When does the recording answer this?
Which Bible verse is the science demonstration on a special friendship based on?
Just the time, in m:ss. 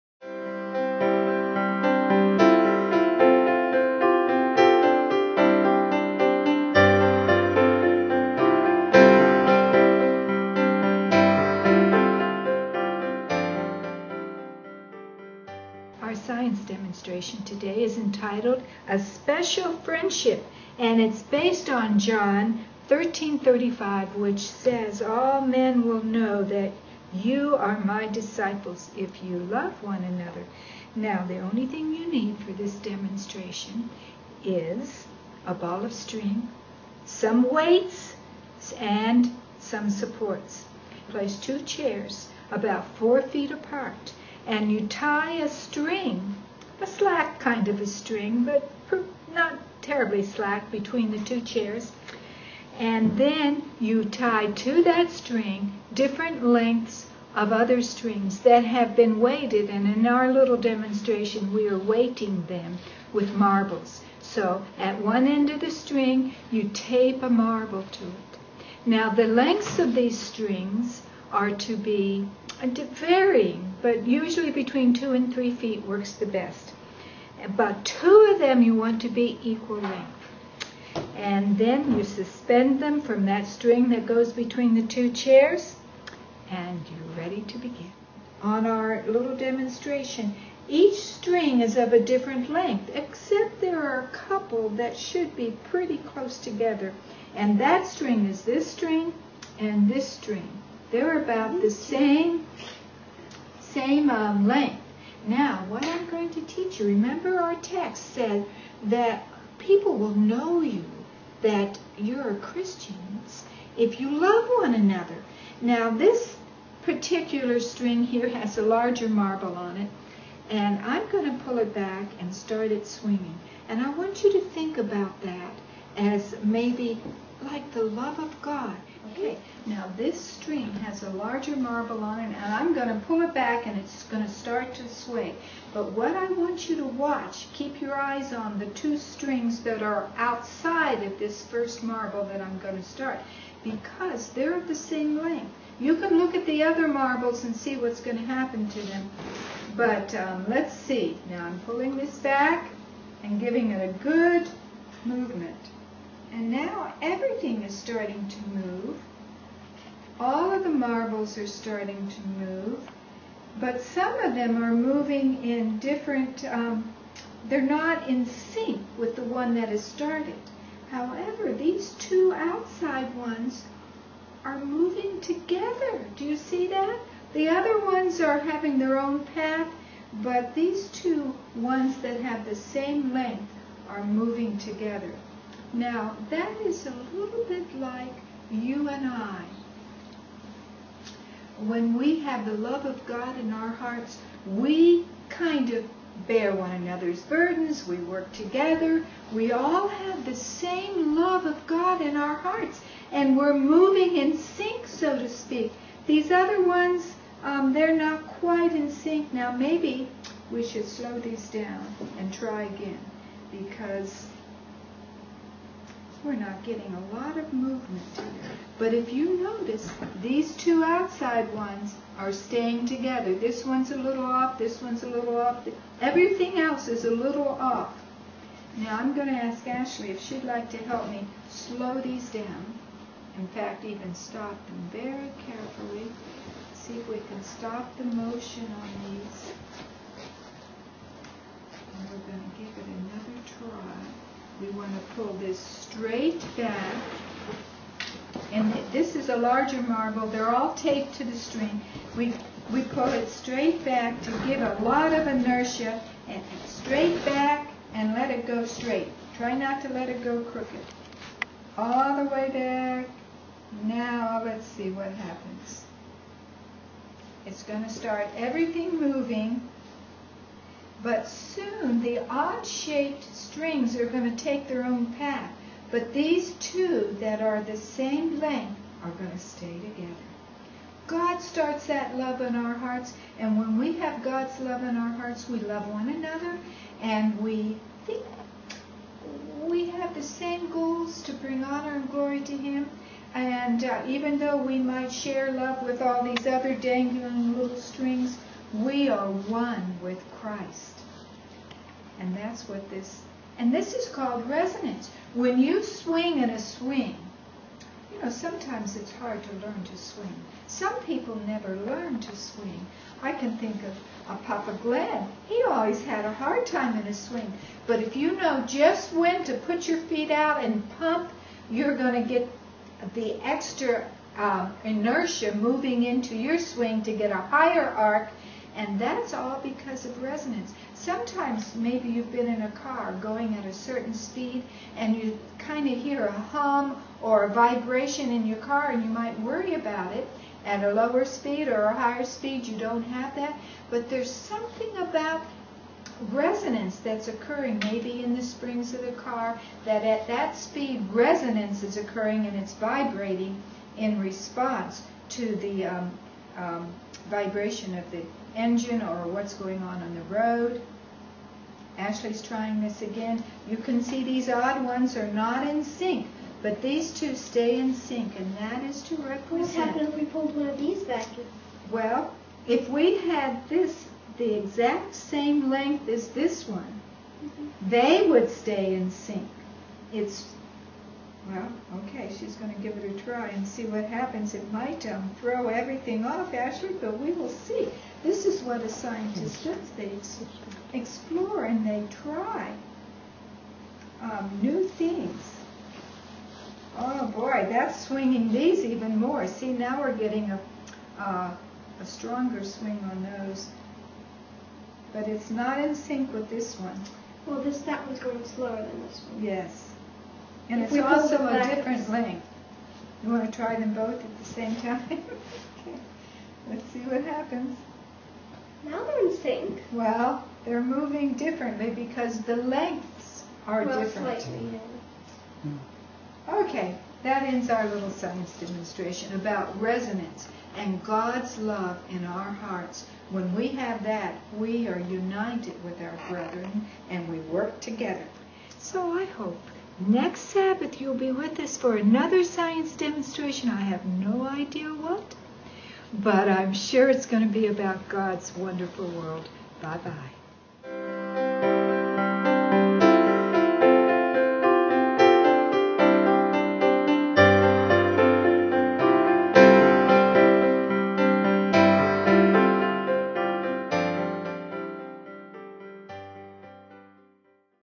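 0:21.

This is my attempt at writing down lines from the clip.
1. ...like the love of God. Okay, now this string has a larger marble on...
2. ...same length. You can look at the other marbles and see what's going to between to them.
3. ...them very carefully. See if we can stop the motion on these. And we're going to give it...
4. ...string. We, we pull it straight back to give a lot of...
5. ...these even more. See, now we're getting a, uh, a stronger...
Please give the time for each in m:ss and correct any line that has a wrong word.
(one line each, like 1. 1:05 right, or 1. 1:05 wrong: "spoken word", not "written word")
1. 2:07 right
2. 2:24 wrong: "happen", not "between"
3. 3:54 right
4. 4:11 right
5. 6:38 right.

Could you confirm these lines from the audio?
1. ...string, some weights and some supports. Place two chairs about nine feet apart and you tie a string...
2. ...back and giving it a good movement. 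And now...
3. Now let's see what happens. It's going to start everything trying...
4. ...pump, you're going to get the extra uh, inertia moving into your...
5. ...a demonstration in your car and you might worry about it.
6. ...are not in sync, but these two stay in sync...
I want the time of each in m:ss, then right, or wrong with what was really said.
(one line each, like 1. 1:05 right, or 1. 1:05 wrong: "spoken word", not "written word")
1. 0:35 wrong: "four", not "nine"
2. 2:32 right
3. 4:23 wrong: "moving", not "trying"
4. 5:20 right
5. 5:37 wrong: "vibration", not "demonstration"
6. 6:05 right.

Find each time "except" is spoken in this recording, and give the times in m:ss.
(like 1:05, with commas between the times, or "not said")
1:32.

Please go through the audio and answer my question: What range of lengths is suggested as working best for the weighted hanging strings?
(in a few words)
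2 to 3 feet.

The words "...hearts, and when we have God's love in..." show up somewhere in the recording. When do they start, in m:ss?
4:42.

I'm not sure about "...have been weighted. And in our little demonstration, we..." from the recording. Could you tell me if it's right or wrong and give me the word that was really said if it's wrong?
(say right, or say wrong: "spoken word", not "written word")
right.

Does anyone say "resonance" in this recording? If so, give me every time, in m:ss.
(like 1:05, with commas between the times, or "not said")
5:04, 5:30, 5:46, 5:51, 7:09.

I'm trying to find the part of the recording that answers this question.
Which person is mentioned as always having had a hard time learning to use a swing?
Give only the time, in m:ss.
5:14.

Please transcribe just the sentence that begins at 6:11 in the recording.
Well, if we had this the exact same length as this one, mm -hmm.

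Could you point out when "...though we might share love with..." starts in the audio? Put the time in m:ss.
4:54.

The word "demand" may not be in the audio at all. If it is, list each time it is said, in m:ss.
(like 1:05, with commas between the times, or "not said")
not said.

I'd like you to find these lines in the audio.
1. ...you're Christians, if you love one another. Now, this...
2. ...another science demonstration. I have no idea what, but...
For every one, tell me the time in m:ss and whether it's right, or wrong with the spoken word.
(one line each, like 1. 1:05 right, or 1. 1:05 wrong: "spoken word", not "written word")
1. 1:51 right
2. 7:21 right.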